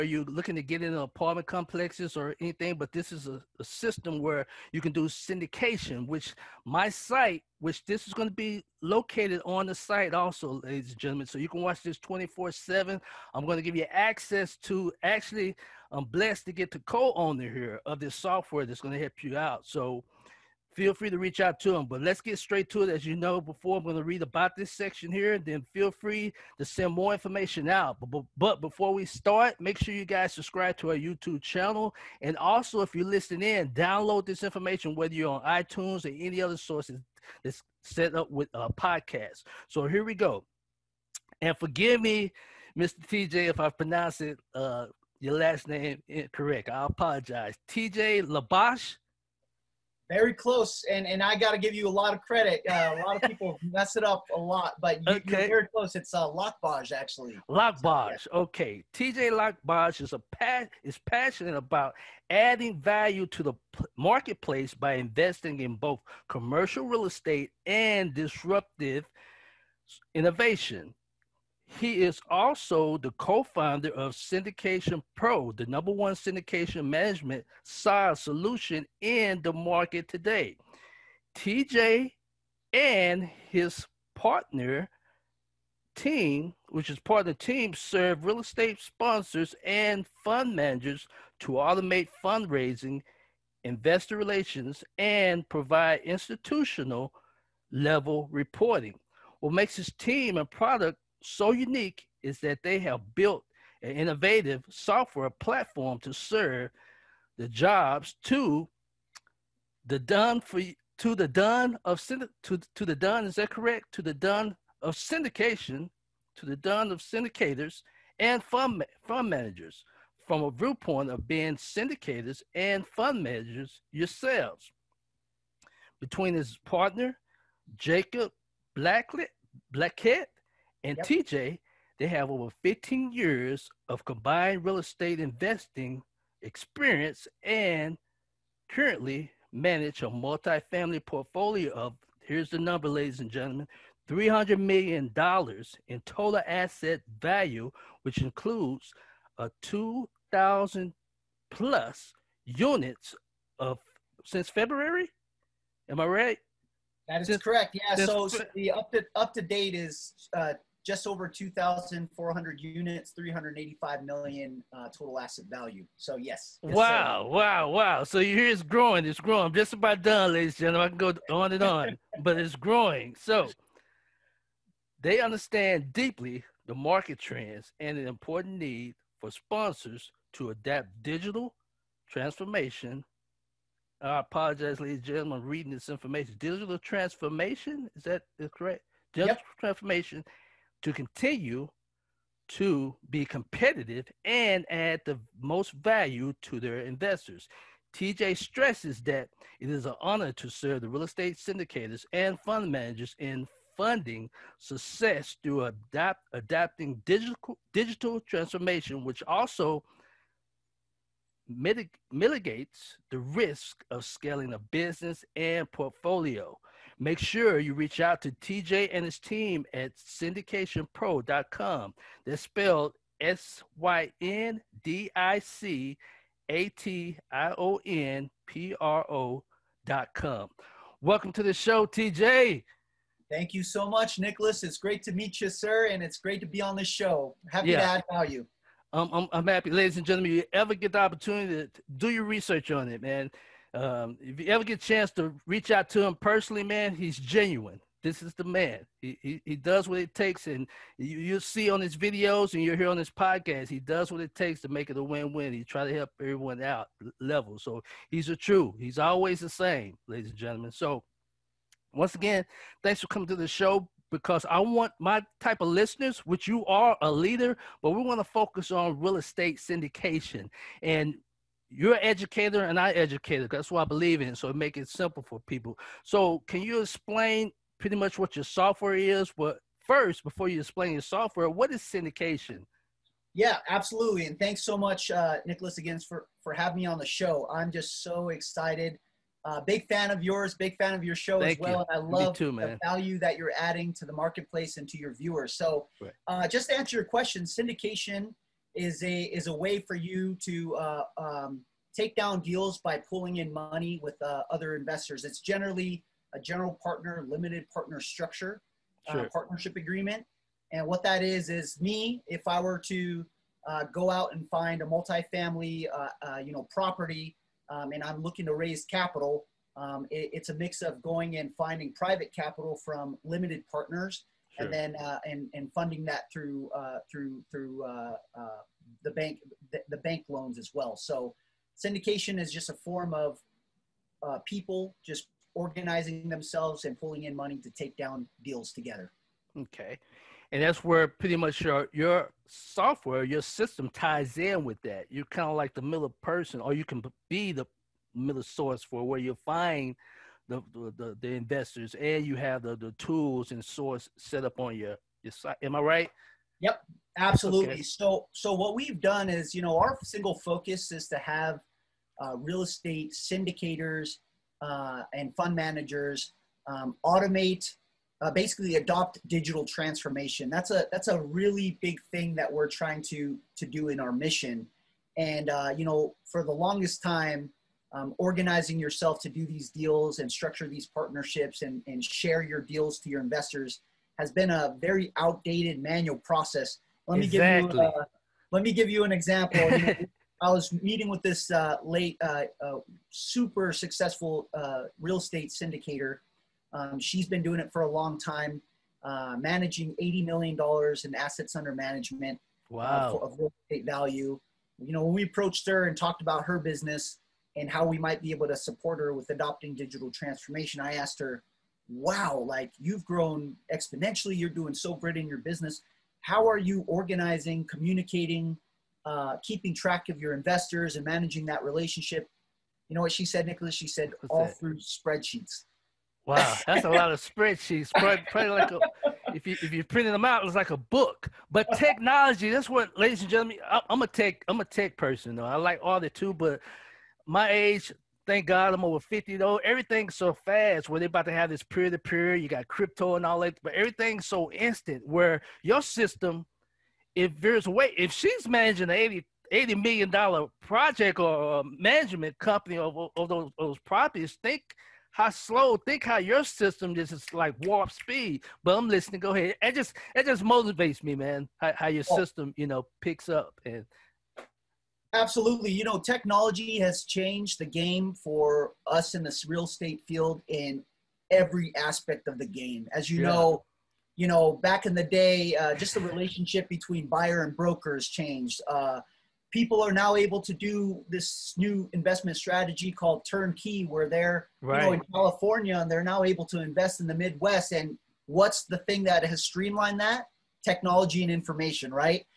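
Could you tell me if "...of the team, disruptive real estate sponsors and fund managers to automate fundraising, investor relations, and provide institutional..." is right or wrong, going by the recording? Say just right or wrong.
wrong.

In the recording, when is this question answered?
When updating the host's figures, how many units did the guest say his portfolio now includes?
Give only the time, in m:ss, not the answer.
2:40.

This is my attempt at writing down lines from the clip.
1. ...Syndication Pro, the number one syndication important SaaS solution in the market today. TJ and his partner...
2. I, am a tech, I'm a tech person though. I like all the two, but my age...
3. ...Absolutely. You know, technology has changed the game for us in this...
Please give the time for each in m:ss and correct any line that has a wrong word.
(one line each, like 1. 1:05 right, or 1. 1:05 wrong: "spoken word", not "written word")
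1. 1:14 wrong: "management", not "important"
2. 7:13 right
3. 7:45 right.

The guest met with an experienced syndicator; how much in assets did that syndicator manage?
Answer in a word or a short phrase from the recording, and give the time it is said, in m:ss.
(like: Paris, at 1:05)
$80 million, at 6:40.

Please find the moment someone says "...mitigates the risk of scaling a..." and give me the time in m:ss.
3:32.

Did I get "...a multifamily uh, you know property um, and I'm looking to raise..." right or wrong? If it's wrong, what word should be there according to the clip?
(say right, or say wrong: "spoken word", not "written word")
right.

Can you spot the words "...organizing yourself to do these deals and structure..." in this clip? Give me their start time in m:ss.
6:18.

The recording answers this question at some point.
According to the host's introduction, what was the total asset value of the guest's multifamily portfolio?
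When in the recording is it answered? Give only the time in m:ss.
2:24.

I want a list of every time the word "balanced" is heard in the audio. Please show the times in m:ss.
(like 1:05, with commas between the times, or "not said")
not said.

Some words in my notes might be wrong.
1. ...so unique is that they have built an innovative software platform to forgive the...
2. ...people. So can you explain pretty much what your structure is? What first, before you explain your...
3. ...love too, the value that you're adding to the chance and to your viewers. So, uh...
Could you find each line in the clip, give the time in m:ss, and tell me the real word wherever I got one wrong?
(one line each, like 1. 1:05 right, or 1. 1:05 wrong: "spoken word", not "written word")
1. 1:41 wrong: "serve", not "forgive"
2. 4:35 wrong: "software", not "structure"
3. 4:51 wrong: "marketplace", not "chance".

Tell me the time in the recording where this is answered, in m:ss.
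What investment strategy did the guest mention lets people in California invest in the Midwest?
8:03.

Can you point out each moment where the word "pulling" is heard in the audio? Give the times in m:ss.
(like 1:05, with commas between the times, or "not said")
5:03, 5:36.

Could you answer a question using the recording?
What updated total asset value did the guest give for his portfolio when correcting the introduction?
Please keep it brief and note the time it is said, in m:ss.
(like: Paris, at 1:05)
$385 million, at 2:43.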